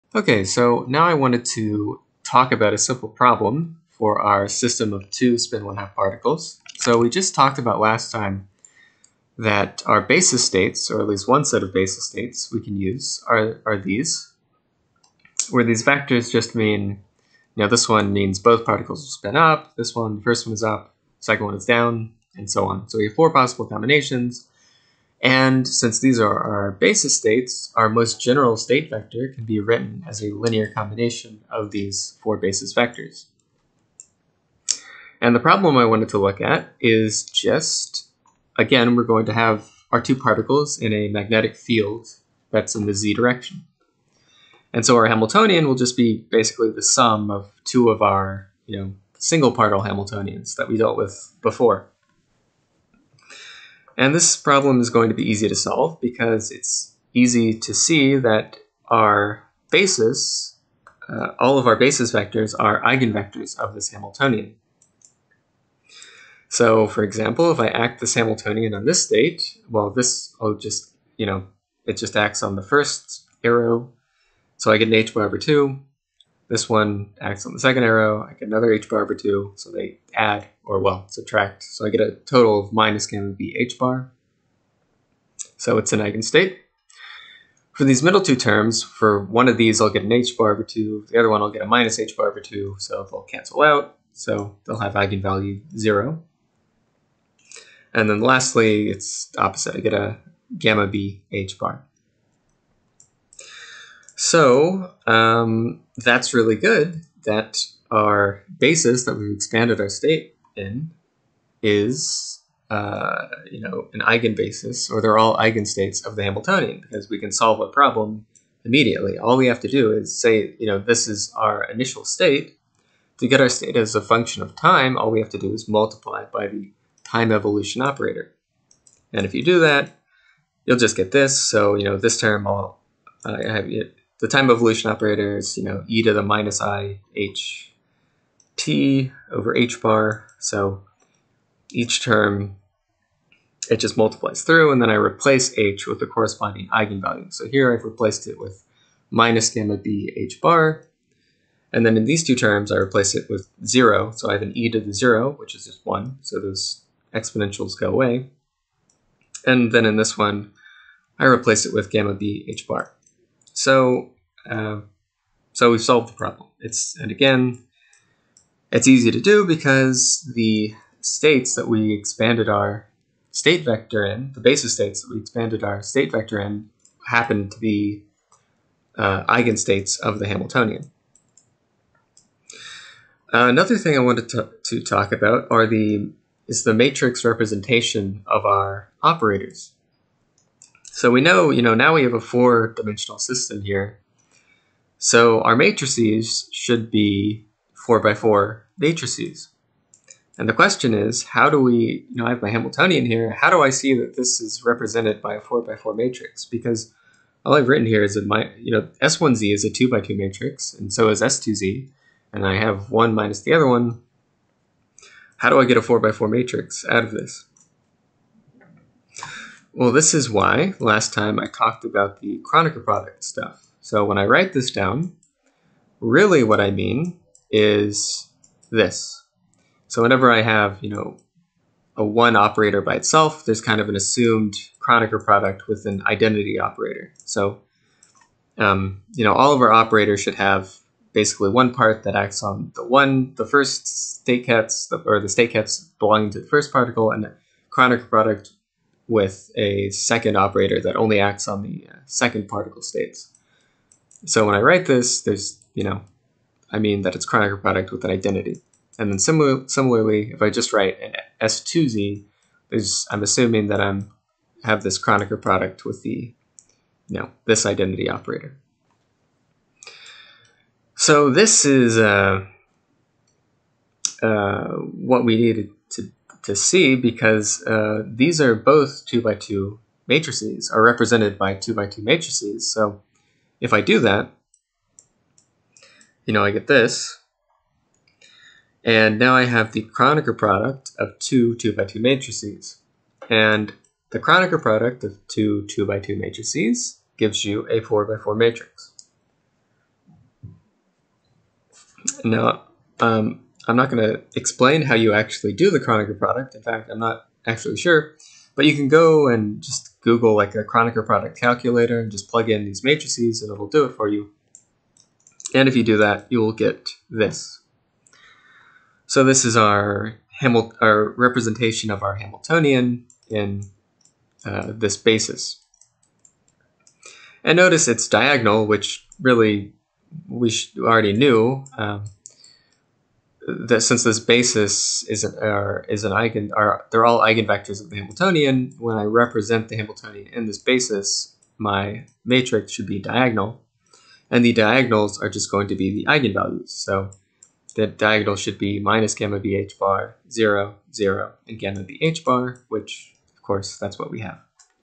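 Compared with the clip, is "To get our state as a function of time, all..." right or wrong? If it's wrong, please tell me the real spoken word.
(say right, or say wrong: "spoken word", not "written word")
right.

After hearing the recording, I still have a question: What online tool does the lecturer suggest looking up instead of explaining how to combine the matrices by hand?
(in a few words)
Kronecker product calculator.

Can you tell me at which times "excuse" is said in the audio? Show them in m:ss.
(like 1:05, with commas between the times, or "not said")
not said.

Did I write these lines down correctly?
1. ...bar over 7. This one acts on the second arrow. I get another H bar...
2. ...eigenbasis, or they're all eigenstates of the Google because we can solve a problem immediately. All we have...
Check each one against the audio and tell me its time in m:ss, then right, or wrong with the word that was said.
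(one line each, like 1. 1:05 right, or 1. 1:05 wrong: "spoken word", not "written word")
1. 1:15 wrong: "2", not "7"
2. 1:54 wrong: "Hamiltonian", not "Google".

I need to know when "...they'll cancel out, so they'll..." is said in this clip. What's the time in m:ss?
1:33.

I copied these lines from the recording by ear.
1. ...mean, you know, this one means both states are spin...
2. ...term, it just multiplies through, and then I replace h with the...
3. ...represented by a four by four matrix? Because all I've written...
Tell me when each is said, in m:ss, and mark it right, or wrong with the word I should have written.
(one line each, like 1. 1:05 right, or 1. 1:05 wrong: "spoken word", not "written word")
1. 0:16 wrong: "particles", not "states"
2. 2:22 right
3. 3:24 right.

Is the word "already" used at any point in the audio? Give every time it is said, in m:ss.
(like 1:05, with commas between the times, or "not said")
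5:30.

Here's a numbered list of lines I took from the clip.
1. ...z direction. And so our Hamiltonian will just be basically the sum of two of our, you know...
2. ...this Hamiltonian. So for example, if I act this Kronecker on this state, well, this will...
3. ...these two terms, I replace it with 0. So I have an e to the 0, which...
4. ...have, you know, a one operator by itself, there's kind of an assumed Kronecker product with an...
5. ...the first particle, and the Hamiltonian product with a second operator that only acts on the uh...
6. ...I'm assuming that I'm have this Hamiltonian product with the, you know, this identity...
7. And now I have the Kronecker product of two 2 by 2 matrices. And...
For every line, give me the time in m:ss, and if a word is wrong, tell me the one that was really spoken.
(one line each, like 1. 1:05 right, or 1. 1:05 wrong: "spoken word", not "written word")
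1. 0:42 right
2. 1:03 wrong: "Hamiltonian", not "Kronecker"
3. 2:32 right
4. 3:50 right
5. 4:06 wrong: "Kronecker", not "Hamiltonian"
6. 4:23 wrong: "Kronecker", not "Hamiltonian"
7. 4:48 right.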